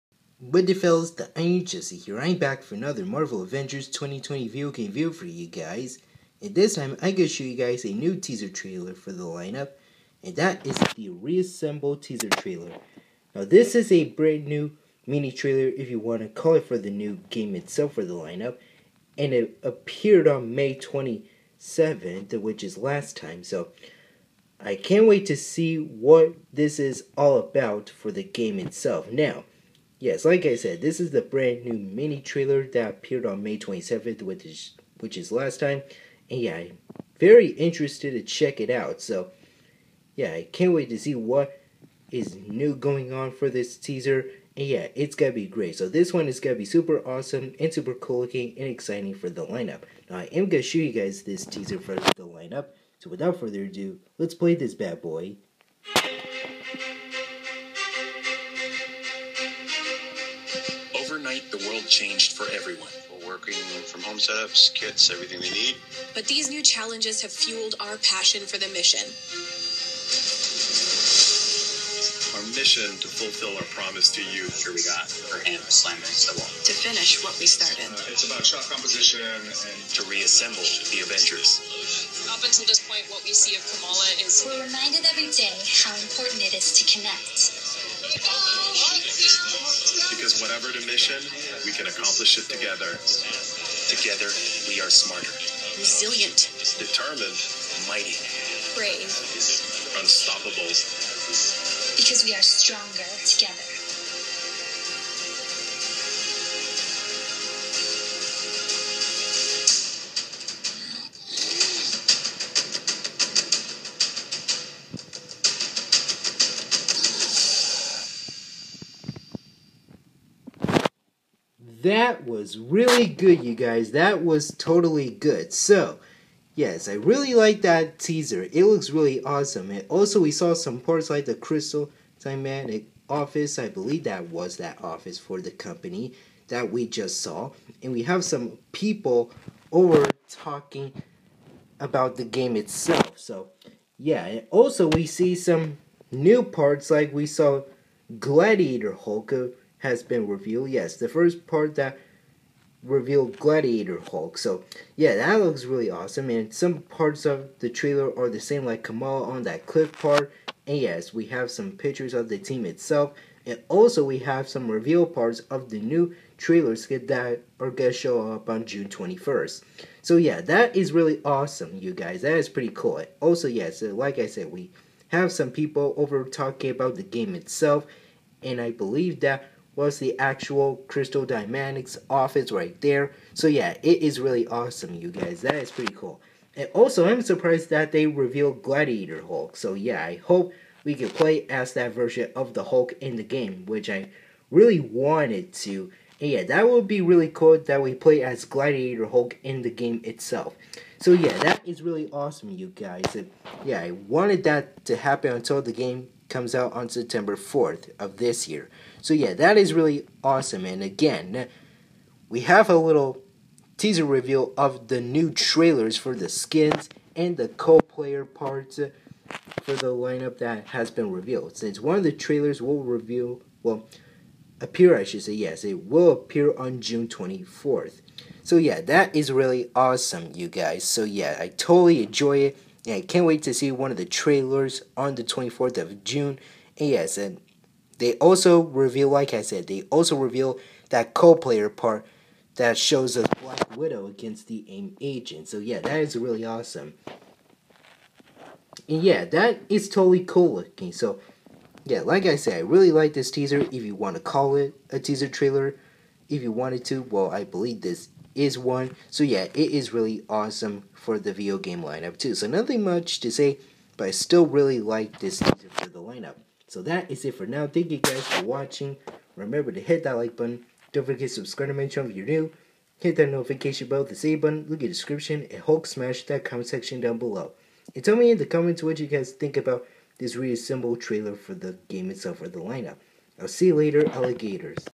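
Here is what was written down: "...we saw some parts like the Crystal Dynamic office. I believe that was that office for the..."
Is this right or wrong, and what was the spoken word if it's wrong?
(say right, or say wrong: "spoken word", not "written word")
right.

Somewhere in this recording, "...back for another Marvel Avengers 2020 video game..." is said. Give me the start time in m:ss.
0:02.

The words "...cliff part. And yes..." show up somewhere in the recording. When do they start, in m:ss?
2:39.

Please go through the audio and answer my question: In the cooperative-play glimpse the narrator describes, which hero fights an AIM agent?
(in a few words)
Black Widow.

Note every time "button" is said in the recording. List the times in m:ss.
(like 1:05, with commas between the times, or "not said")
4:30, 4:34.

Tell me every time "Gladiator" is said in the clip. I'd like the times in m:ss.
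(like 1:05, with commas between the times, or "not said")
2:28, 2:33, 3:08, 3:18.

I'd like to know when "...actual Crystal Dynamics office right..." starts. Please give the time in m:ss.
3:00.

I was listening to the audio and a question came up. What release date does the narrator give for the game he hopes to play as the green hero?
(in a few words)
September 4th.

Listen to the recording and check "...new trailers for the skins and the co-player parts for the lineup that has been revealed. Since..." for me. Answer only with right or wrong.
right.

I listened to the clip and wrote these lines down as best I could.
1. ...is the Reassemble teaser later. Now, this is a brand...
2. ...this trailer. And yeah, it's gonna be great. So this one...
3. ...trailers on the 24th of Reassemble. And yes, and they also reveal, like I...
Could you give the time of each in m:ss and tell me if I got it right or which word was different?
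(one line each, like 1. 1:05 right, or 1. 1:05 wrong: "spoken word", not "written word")
1. 0:10 wrong: "trailer", not "later"
2. 0:43 wrong: "teaser", not "trailer"
3. 3:54 wrong: "June", not "Reassemble".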